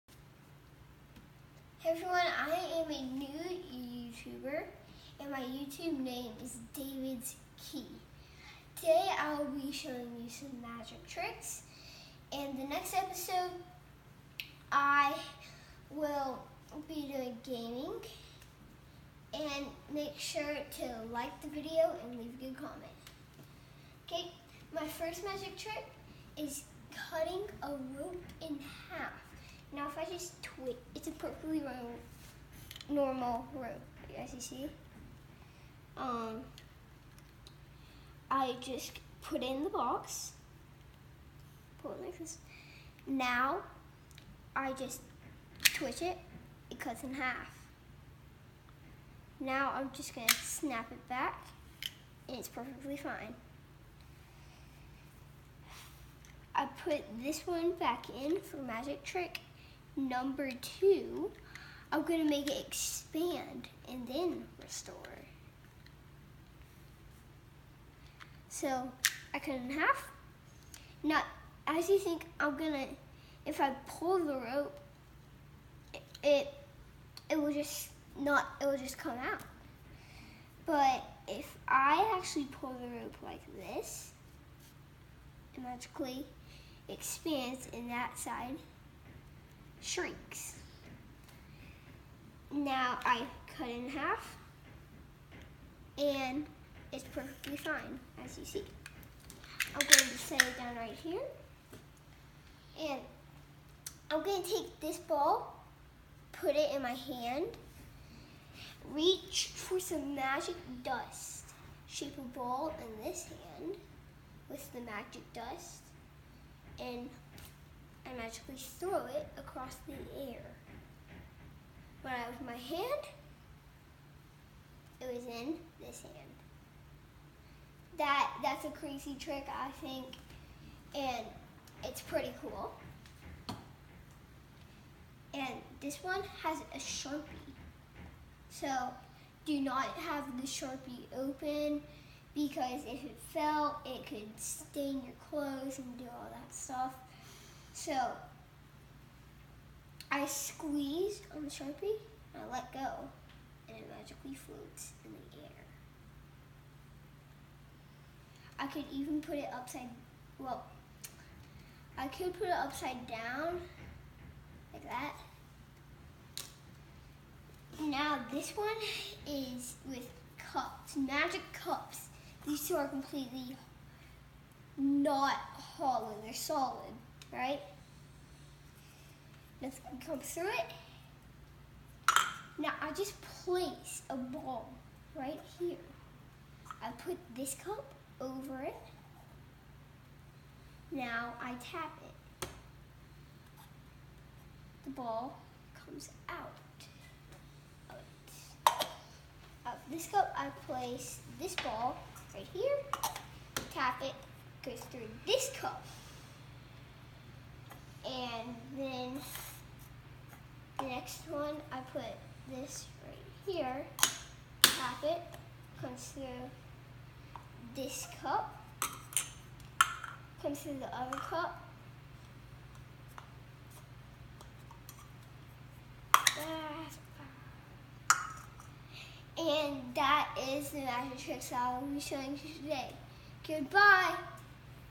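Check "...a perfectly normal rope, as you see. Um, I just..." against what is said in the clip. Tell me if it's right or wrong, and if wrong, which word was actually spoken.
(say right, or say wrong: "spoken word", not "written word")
right.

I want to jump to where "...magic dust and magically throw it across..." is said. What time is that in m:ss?
1:54.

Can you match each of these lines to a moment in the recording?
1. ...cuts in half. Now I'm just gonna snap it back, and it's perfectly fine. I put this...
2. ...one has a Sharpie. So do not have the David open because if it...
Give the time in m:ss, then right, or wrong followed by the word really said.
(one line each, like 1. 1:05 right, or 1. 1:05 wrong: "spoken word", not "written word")
1. 0:46 right
2. 2:16 wrong: "Sharpie", not "David".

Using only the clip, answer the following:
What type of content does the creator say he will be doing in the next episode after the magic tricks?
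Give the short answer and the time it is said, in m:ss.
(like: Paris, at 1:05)
gaming, at 0:17.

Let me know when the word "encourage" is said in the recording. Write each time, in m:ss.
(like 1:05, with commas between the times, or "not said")
not said.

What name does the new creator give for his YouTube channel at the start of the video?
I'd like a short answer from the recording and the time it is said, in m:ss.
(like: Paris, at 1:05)
David's Key, at 0:06.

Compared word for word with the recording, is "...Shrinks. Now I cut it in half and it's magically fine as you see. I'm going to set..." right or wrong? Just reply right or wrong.
wrong.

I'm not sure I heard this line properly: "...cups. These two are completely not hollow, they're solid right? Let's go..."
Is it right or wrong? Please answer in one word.
right.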